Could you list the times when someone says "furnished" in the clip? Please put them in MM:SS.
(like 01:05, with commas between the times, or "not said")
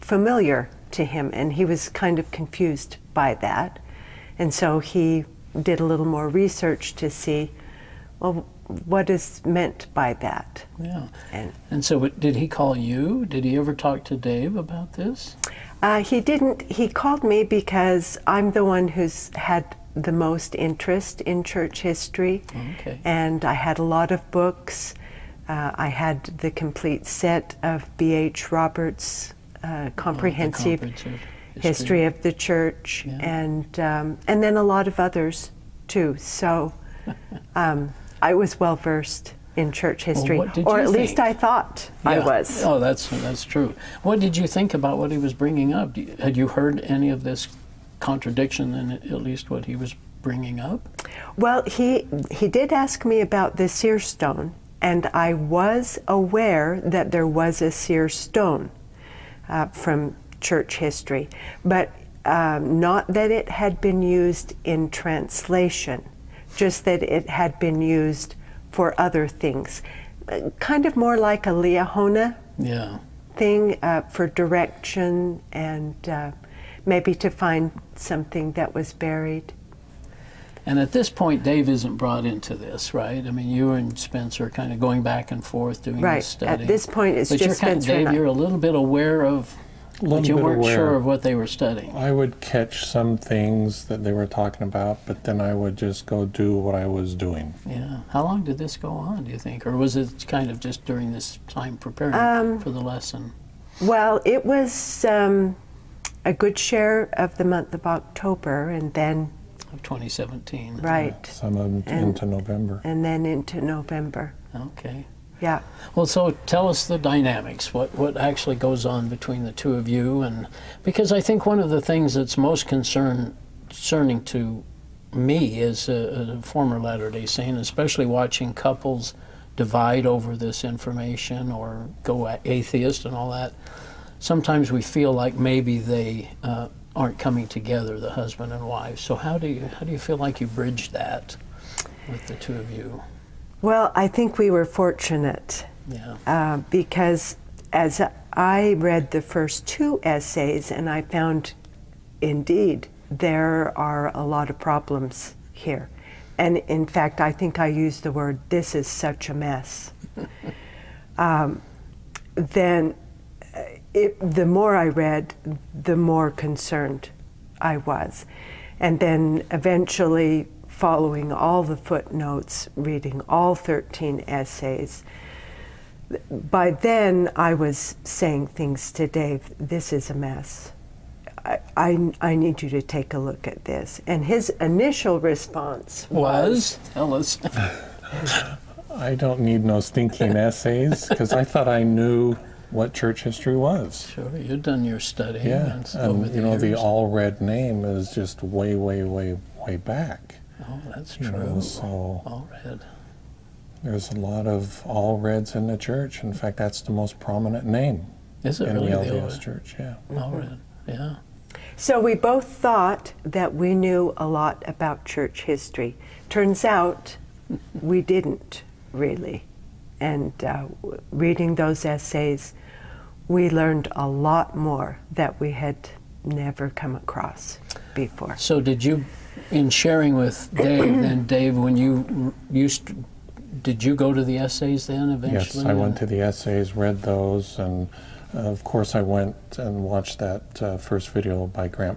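not said.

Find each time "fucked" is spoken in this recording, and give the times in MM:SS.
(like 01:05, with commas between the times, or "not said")
not said.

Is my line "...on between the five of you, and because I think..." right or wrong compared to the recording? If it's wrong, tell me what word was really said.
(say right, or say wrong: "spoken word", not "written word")
wrong: "two", not "five".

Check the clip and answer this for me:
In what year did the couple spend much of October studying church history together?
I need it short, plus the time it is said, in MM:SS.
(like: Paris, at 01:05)
2017, at 01:49.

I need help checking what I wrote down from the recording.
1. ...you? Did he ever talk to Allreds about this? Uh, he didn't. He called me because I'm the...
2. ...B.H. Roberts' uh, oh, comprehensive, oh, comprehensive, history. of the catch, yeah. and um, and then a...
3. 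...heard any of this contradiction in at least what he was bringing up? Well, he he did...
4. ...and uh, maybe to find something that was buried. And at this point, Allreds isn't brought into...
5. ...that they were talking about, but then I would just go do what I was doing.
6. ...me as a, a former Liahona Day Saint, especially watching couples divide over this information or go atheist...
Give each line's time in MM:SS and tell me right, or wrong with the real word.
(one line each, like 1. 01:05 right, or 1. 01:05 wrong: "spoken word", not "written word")
1. 00:12 wrong: "Dave", not "Allreds"
2. 00:27 wrong: "church", not "catch"
3. 00:46 right
4. 01:15 wrong: "Dave", not "Allreds"
5. 01:33 right
6. 02:05 wrong: "Latter", not "Liahona".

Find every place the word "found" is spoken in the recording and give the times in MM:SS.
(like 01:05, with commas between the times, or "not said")
02:31.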